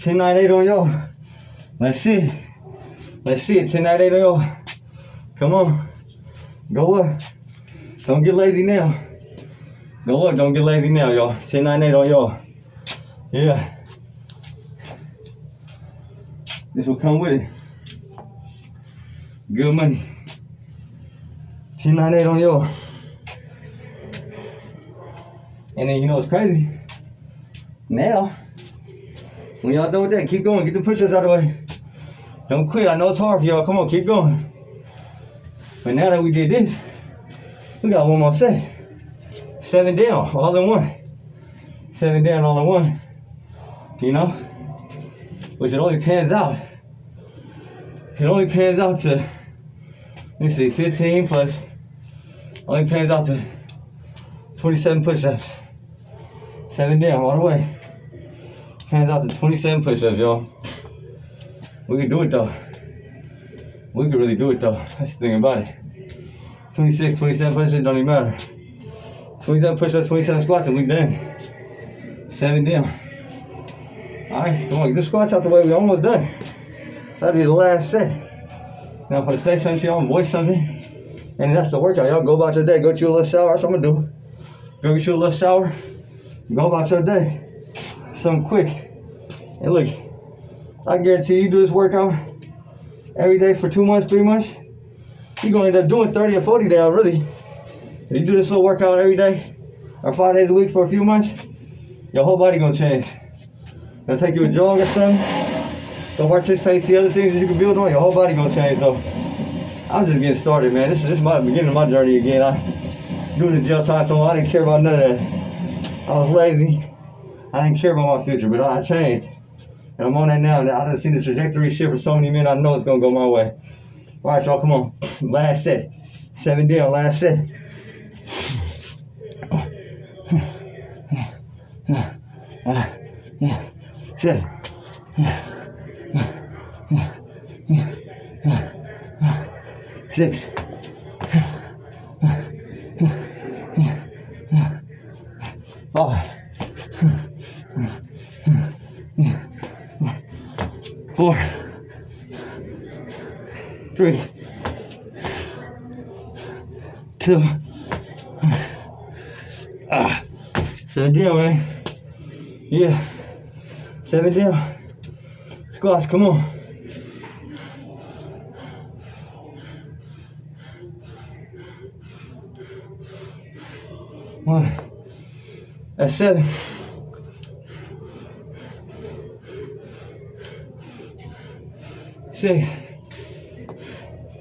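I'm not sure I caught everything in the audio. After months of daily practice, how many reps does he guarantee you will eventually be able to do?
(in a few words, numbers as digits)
30 or 40.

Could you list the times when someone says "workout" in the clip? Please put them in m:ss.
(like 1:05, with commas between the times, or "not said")
1:21, 1:31, 1:38.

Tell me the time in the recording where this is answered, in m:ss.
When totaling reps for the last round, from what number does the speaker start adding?
0:50.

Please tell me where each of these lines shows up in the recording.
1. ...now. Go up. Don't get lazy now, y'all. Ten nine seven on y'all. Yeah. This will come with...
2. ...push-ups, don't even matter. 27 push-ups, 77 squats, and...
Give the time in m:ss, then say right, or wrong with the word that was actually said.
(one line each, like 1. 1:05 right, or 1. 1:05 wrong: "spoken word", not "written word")
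1. 0:08 wrong: "eight", not "seven"
2. 1:07 wrong: "27", not "77".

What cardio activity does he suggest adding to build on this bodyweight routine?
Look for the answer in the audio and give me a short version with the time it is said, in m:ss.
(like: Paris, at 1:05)
a jog, at 1:44.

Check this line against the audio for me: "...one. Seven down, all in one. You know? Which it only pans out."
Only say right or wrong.
right.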